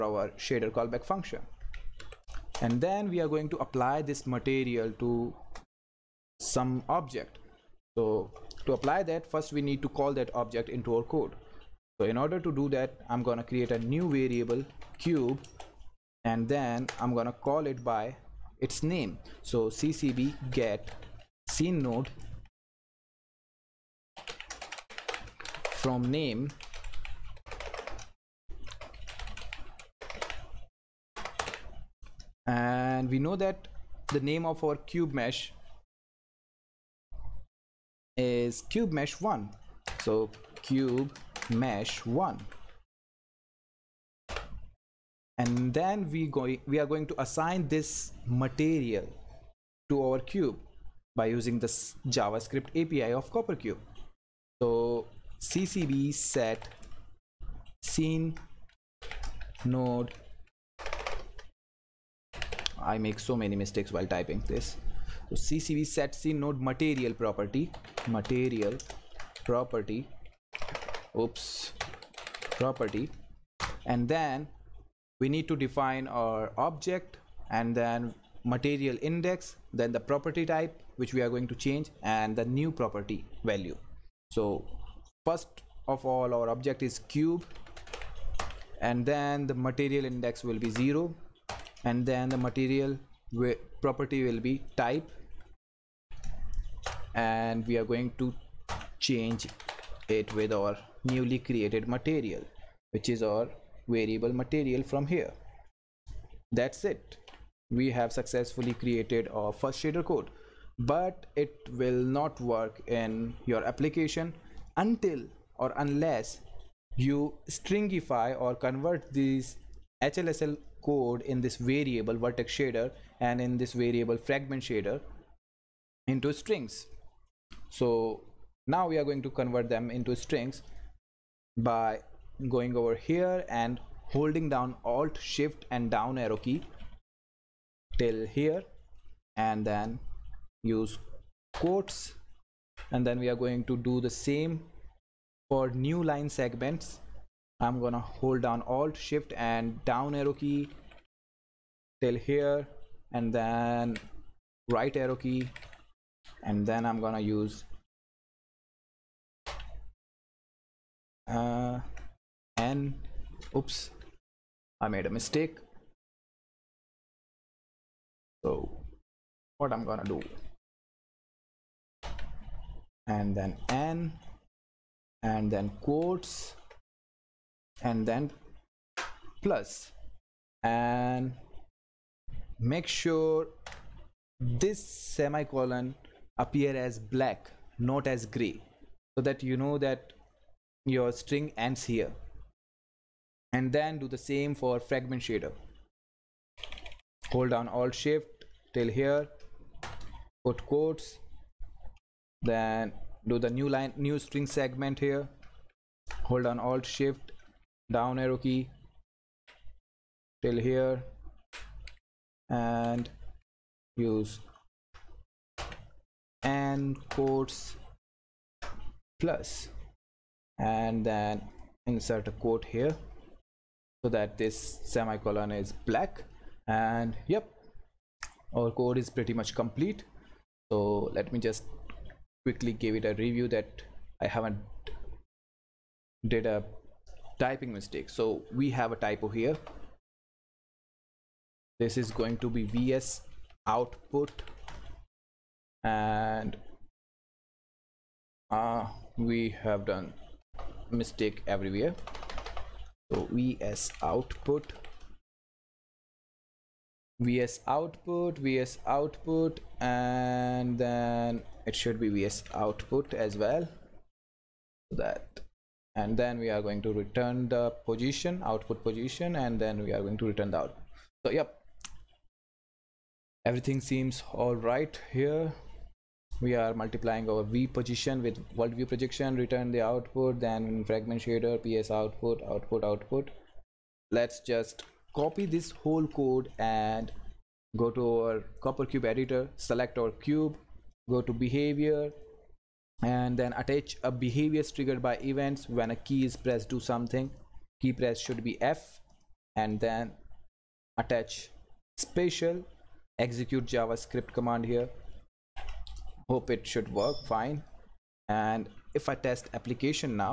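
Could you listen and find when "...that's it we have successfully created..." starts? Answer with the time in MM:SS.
01:46.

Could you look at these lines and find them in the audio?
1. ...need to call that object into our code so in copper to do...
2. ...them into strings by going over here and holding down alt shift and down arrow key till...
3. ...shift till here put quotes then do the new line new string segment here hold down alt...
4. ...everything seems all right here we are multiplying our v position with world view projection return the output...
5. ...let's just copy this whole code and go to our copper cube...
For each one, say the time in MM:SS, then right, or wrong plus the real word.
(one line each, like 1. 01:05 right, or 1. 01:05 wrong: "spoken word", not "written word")
1. 00:09 wrong: "order", not "copper"
2. 02:09 right
3. 03:17 right
4. 04:33 right
5. 04:44 right.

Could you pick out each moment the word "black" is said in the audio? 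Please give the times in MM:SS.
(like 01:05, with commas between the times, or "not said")
03:06, 03:45.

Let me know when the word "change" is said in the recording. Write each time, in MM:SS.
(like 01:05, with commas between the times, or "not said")
01:21, 01:38.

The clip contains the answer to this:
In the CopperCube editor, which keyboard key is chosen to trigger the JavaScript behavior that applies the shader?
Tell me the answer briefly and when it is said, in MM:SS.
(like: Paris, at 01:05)
F, at 04:58.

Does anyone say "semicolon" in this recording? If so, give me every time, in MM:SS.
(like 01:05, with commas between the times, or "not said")
03:04, 03:44.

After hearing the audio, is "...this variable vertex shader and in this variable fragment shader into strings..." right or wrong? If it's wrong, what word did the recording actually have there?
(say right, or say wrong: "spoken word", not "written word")
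right.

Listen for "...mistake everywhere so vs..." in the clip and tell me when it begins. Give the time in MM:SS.
04:10.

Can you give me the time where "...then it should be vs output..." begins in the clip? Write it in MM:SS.
04:20.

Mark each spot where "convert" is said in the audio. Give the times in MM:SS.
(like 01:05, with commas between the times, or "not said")
01:58, 02:09.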